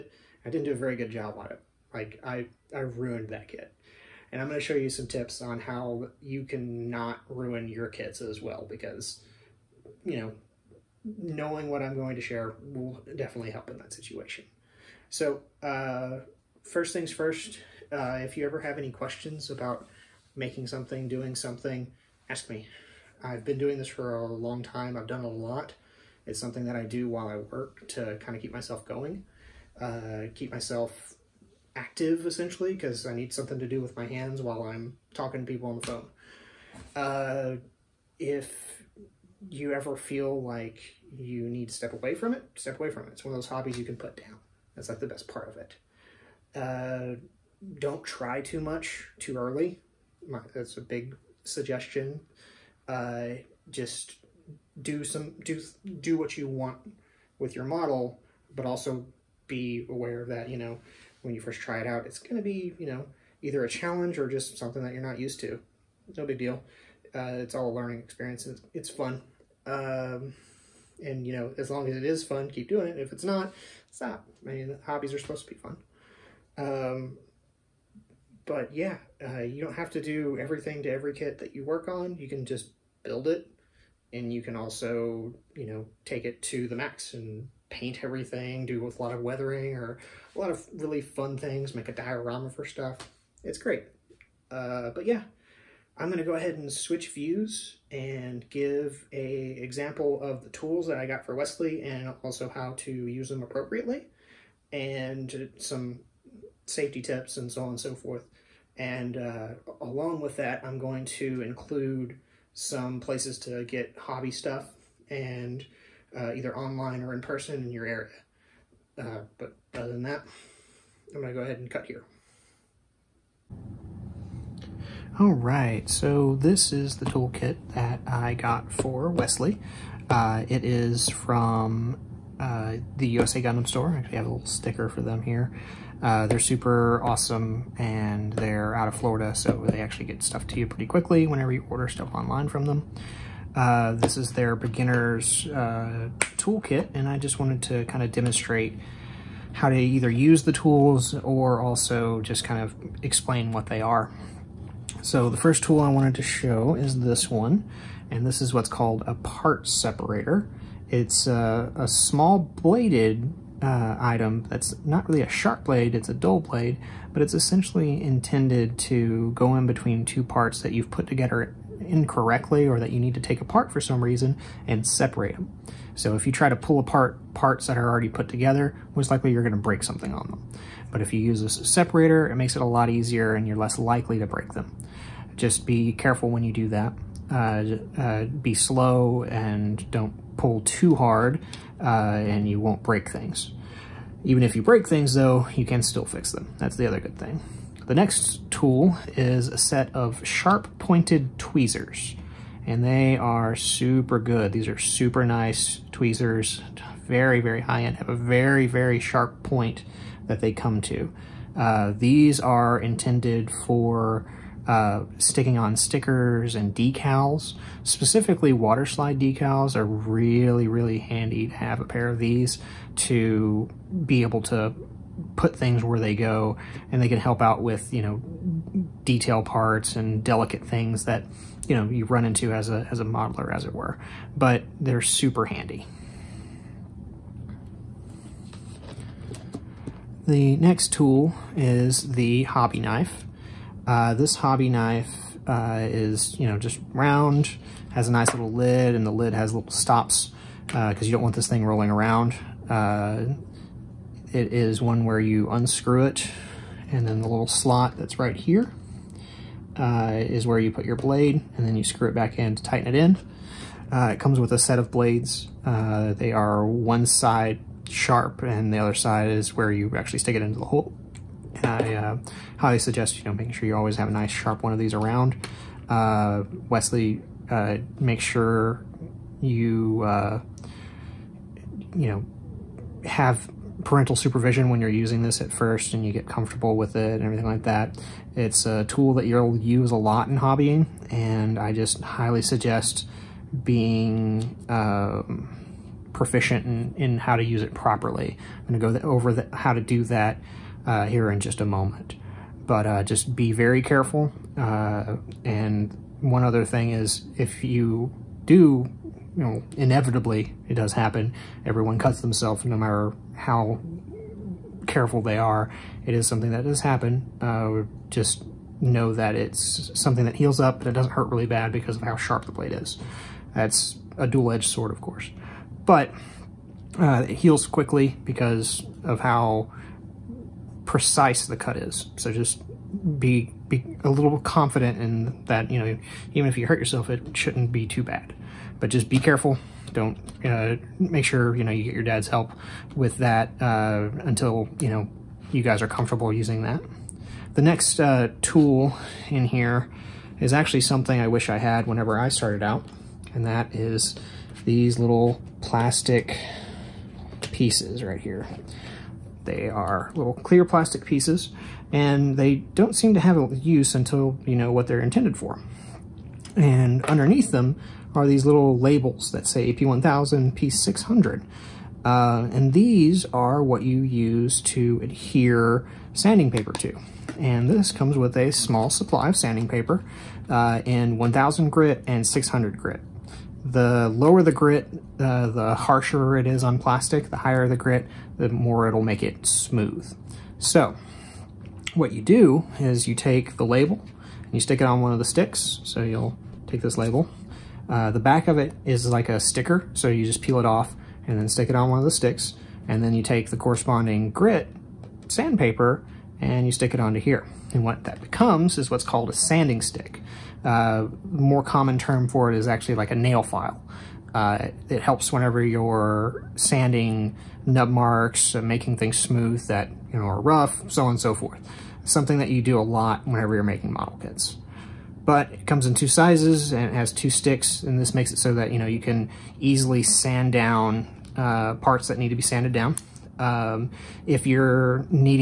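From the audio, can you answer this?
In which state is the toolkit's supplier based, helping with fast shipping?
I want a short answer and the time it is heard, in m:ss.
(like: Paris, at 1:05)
Florida, at 2:18.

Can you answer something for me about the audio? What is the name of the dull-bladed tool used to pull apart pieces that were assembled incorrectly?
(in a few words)
part separator.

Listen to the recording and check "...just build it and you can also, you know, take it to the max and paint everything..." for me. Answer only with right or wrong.
right.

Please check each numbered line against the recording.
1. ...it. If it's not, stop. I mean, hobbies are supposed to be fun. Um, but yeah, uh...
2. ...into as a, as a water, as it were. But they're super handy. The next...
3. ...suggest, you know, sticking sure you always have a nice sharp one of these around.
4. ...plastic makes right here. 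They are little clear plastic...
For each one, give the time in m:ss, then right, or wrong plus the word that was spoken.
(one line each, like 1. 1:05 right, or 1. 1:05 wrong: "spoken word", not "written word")
1. 1:12 right
2. 3:52 wrong: "modeler", not "water"
3. 4:32 wrong: "making", not "sticking"
4. 5:55 wrong: "pieces", not "makes".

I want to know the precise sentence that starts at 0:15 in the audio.
So uh, first things first, uh, if you ever have any questions about making something, doing something, ask me.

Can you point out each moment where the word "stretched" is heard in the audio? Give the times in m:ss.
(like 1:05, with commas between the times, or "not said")
not said.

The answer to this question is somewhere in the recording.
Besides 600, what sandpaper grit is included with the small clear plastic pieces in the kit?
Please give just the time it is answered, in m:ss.
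6:21.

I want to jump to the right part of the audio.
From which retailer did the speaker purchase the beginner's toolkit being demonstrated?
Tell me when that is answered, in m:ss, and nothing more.
2:13.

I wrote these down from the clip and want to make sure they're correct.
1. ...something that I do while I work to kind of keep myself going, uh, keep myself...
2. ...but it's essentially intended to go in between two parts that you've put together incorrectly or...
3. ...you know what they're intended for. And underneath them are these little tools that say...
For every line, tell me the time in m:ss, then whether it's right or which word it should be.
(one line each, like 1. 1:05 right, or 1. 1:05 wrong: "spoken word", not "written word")
1. 0:26 right
2. 2:47 right
3. 6:04 wrong: "labels", not "tools".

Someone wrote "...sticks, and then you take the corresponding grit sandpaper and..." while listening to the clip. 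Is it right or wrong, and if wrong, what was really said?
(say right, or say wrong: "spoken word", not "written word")
right.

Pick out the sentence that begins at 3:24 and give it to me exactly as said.
These are super nice tweezers, very, very high end, have a very, very sharp point that they come to.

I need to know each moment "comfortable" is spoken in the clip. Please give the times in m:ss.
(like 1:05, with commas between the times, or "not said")
4:46, 5:45.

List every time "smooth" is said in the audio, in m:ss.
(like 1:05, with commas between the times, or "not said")
6:29, 6:59.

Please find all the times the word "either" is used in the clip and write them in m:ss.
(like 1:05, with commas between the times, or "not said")
1:03, 1:56, 2:29.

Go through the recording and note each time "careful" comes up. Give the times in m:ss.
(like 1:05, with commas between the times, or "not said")
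3:05, 5:03, 5:14, 5:39.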